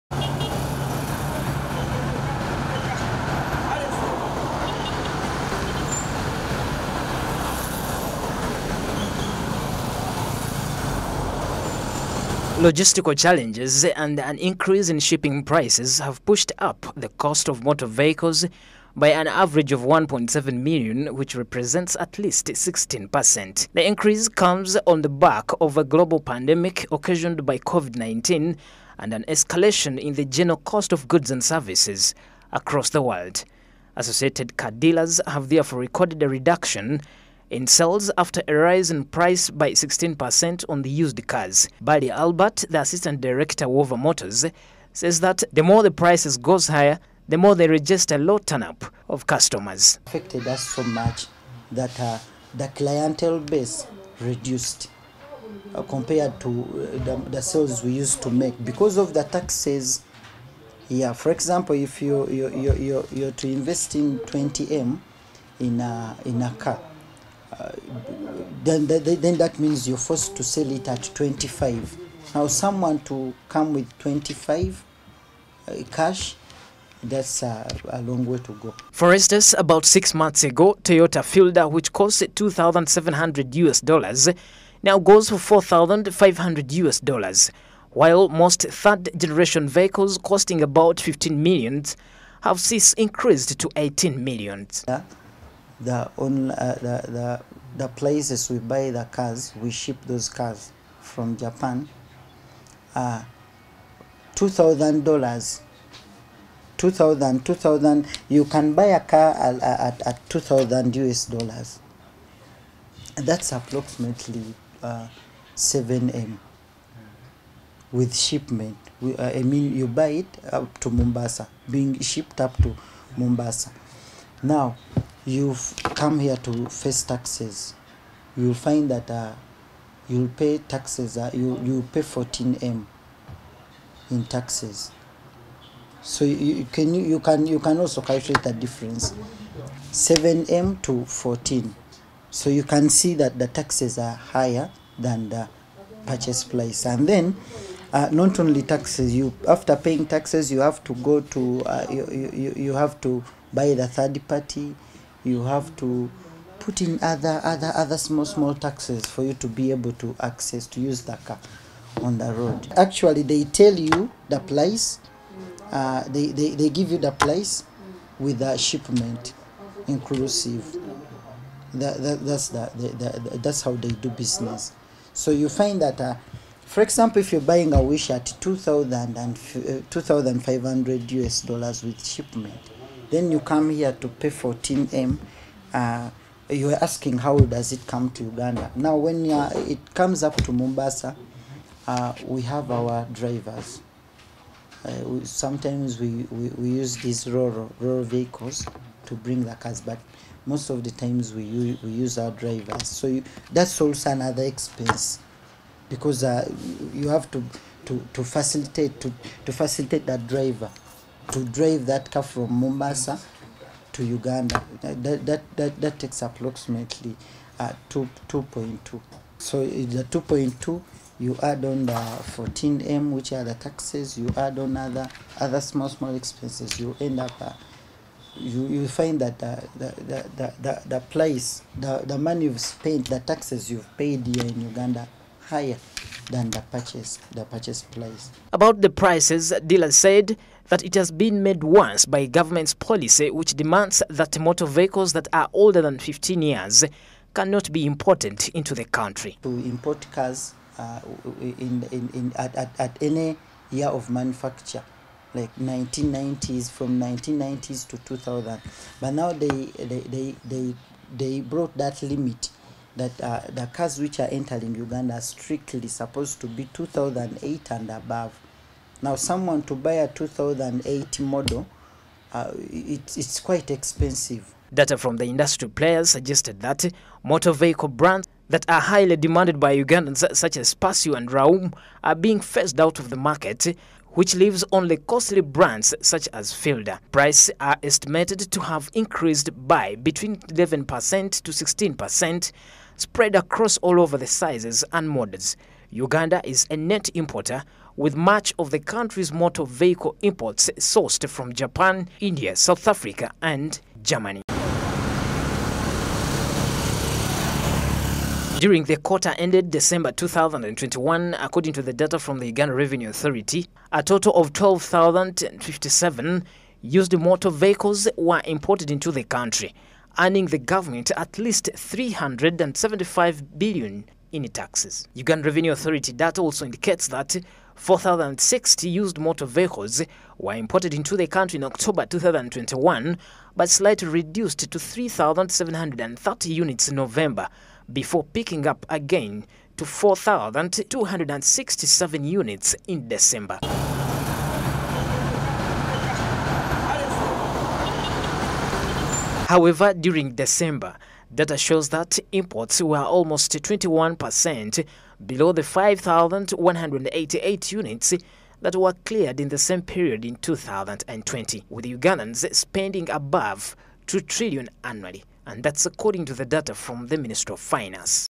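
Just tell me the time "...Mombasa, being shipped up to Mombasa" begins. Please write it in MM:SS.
02:00.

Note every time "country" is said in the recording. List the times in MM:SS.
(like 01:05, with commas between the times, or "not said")
04:08, 04:58, 05:19, 05:31.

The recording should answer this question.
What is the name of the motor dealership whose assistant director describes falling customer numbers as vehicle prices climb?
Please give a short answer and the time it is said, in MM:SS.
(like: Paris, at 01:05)
Wover Motors, at 00:43.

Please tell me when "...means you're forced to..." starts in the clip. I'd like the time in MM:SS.
01:09.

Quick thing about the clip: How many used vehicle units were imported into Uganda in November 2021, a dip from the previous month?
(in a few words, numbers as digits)
3,730.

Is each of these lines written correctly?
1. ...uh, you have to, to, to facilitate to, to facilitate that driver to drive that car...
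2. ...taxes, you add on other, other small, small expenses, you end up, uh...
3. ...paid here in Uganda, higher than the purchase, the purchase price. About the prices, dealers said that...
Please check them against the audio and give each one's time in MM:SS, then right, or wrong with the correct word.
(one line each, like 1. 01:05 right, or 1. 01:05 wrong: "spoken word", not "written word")
1. 03:26 right
2. 03:43 right
3. 03:53 right.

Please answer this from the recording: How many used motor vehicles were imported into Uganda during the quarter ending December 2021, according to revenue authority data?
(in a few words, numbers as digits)
12,057.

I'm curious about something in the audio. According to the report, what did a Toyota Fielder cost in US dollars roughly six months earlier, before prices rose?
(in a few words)
2,700 US dollars.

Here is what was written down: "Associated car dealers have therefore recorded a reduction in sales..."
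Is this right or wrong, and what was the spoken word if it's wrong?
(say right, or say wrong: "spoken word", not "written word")
right.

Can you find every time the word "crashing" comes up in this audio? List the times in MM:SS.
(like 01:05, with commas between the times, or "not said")
not said.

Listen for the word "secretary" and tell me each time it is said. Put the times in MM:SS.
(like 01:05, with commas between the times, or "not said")
not said.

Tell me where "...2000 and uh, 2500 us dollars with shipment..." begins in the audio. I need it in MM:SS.
02:58.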